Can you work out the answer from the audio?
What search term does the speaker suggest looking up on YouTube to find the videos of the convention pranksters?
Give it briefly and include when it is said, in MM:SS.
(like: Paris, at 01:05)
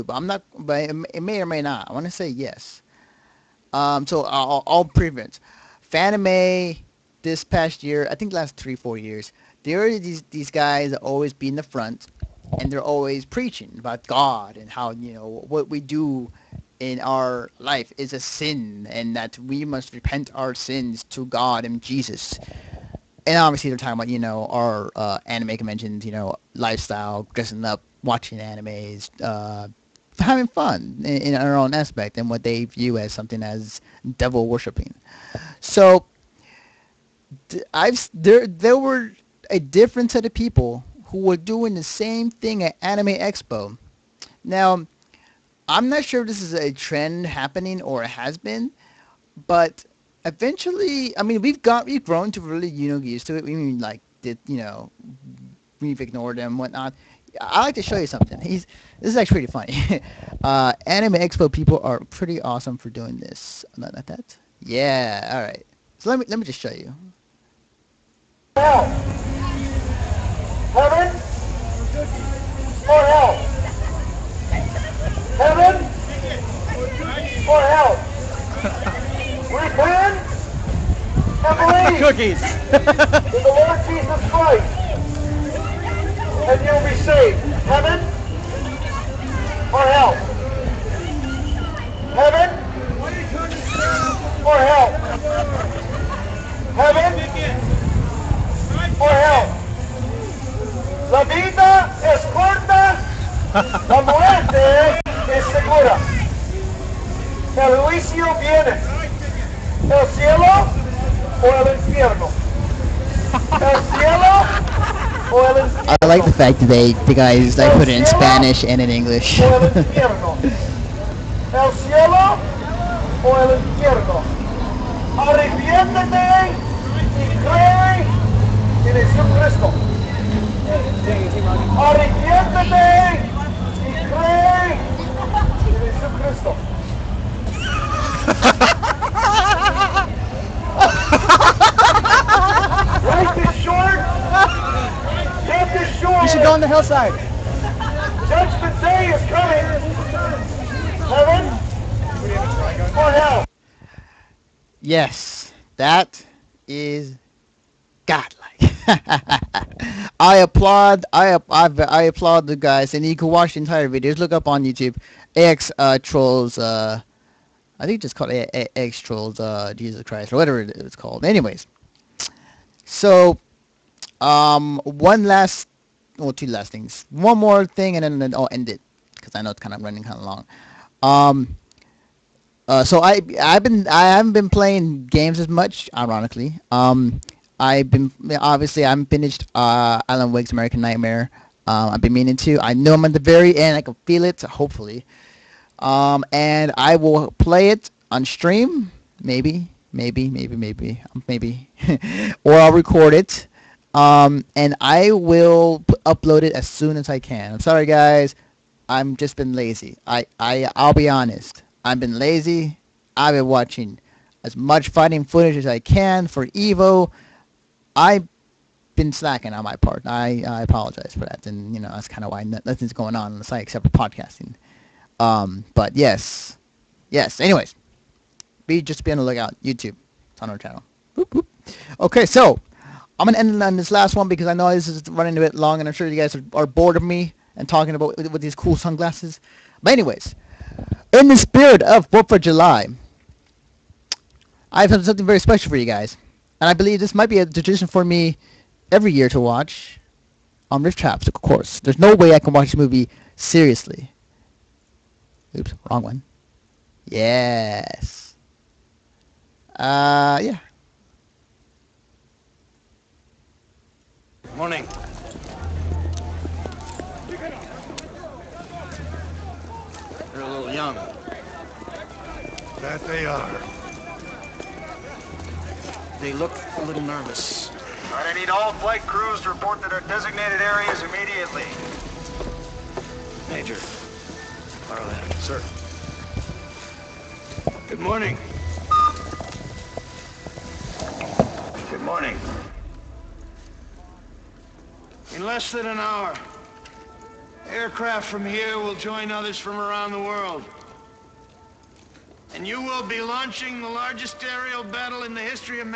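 AX trolls, at 02:48.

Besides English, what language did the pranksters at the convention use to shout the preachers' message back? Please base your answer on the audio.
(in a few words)
Spanish.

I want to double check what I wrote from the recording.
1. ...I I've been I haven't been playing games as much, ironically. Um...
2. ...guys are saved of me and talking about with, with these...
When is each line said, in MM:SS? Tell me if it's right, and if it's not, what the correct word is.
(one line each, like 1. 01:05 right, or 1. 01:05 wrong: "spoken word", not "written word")
1. 03:03 right
2. 03:56 wrong: "bored", not "saved".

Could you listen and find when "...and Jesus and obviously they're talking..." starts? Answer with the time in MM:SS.
00:21.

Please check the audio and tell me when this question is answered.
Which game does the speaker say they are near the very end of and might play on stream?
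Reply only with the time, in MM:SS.
03:10.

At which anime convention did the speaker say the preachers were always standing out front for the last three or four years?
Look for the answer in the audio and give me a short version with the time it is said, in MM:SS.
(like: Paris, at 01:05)
Fanime, at 00:05.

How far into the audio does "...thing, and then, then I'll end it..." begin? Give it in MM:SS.
02:57.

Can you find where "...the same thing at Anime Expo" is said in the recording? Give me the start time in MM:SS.
00:41.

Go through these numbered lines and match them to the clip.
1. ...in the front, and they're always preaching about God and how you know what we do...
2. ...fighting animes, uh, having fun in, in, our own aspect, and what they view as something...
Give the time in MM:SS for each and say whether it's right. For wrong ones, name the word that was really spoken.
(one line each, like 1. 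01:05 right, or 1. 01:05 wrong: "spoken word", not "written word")
1. 00:11 right
2. 00:28 wrong: "watching", not "fighting".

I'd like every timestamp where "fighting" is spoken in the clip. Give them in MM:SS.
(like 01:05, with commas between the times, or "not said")
03:34.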